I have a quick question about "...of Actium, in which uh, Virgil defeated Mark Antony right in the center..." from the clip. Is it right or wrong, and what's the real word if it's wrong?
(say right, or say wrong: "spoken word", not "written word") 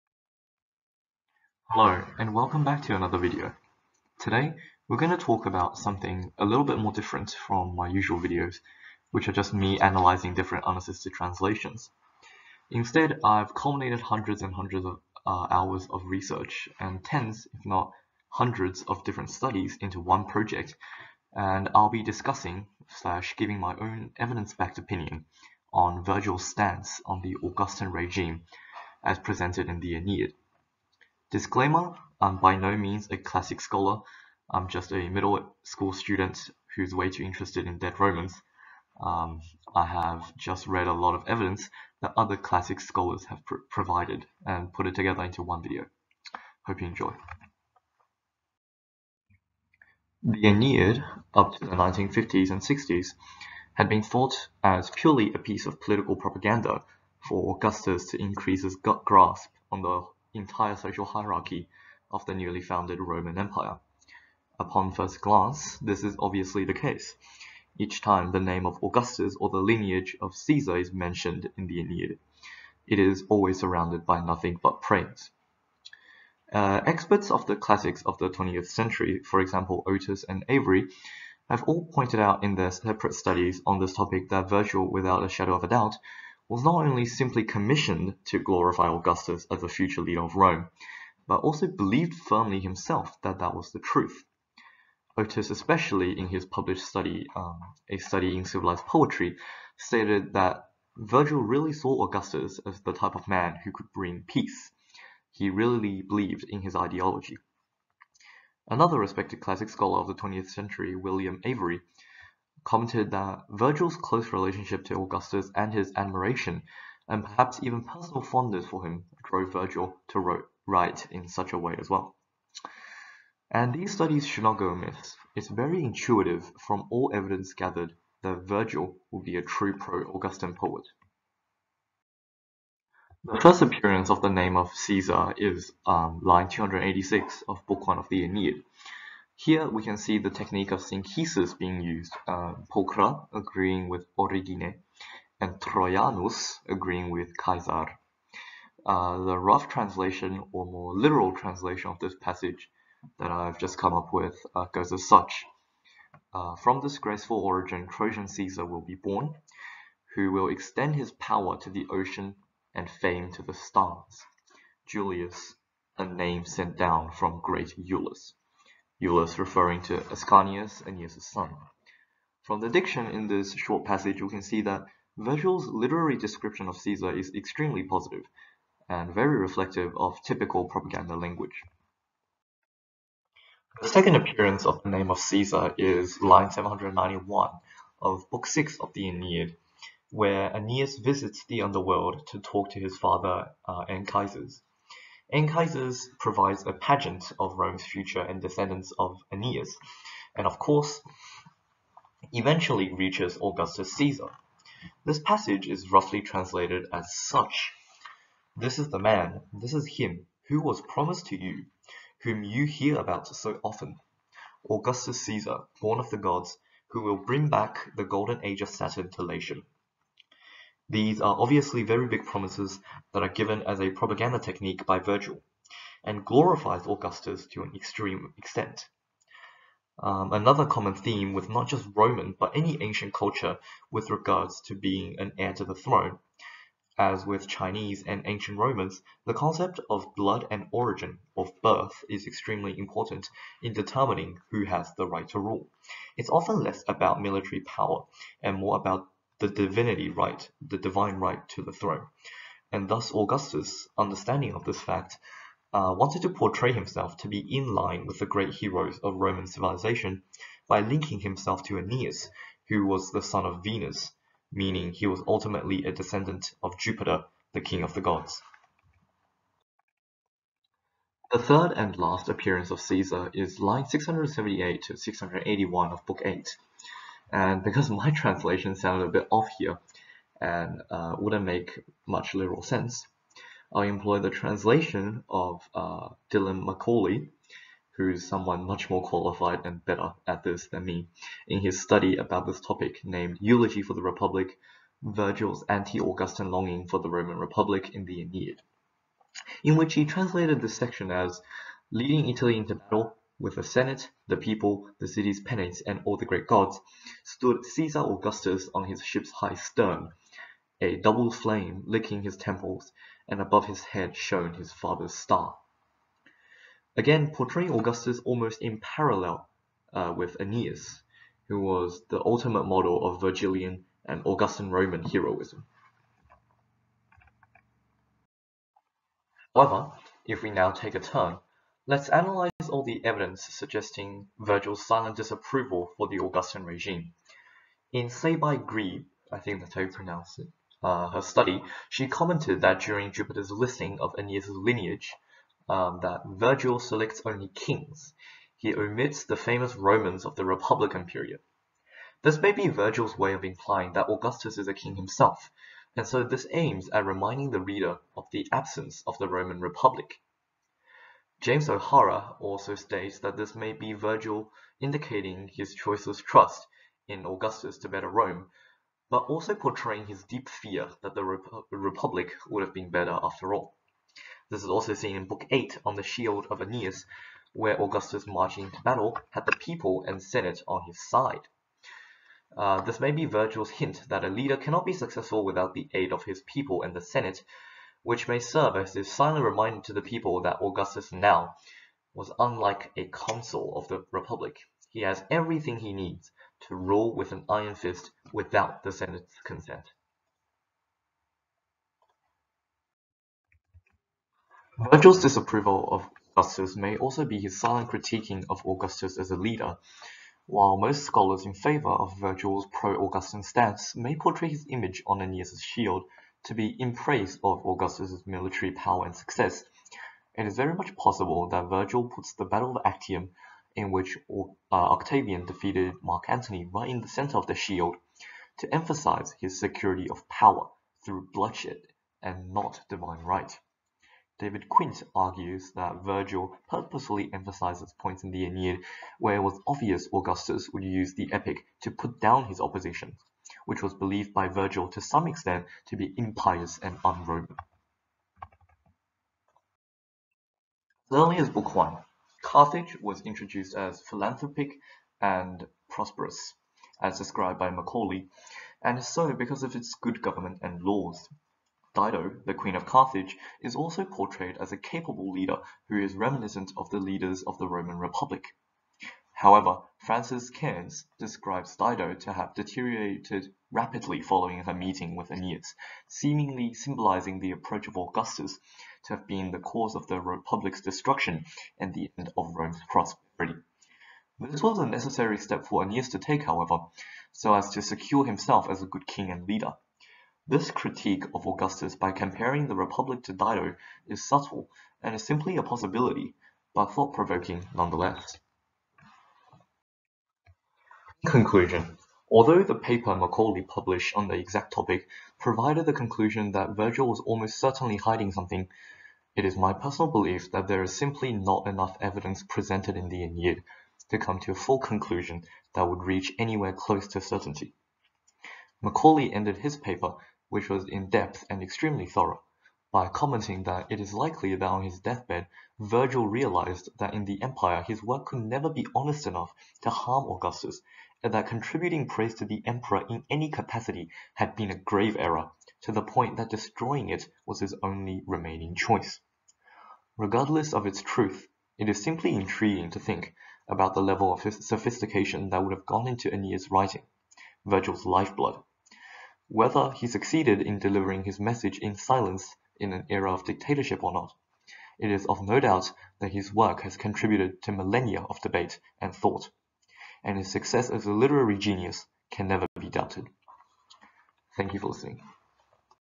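wrong: "Octavian", not "Virgil".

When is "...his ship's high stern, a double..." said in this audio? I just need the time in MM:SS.
05:08.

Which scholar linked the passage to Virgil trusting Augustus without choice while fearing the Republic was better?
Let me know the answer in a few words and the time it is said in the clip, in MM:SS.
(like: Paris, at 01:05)
James O'Hara, at 06:01.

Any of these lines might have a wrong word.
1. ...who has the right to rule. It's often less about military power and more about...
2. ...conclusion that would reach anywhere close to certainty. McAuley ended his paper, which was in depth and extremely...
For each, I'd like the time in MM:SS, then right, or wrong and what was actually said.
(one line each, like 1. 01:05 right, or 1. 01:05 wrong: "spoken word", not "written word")
1. 04:04 right
2. 08:34 right.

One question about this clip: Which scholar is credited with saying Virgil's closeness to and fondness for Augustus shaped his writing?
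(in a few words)
William Avery.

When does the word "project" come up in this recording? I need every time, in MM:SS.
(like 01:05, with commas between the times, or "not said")
00:20.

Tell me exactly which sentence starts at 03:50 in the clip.
Um, another common theme with not just Roman but any ancient culture with regards to being an heir to the throne.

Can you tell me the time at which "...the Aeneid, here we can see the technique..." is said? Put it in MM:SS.
02:18.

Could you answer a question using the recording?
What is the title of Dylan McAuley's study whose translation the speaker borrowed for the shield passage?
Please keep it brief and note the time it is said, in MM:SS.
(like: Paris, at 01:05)
Eulogy for the Republic, at 04:53.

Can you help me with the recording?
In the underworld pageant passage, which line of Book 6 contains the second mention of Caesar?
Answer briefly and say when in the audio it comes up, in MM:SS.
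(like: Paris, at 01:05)
791, at 03:06.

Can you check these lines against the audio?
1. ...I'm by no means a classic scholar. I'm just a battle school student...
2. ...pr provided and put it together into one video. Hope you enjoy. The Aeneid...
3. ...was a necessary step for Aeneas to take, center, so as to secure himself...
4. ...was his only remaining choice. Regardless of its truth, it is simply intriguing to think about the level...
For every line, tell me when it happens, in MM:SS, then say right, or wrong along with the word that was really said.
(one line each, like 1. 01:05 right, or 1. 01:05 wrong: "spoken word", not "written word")
1. 00:32 wrong: "middle", not "battle"
2. 00:43 right
3. 08:04 wrong: "however", not "center"
4. 08:57 right.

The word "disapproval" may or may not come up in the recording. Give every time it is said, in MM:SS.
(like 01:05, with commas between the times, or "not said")
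05:35, 06:45.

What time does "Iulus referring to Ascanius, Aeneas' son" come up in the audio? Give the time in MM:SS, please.
02:49.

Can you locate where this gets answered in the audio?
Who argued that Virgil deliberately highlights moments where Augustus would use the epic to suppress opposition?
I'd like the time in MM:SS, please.
07:14.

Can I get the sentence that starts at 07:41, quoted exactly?
Dido, the queen of Carthage, is also portrayed as a capable leader who is reminiscent of the leaders of the Roman Republic.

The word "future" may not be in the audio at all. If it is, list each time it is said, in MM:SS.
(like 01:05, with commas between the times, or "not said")
01:29, 03:17.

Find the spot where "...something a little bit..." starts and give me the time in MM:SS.
00:05.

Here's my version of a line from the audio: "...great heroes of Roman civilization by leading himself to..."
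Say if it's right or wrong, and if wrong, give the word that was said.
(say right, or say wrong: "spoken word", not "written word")
wrong: "linking", not "leading".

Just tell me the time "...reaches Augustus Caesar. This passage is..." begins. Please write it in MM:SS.
03:22.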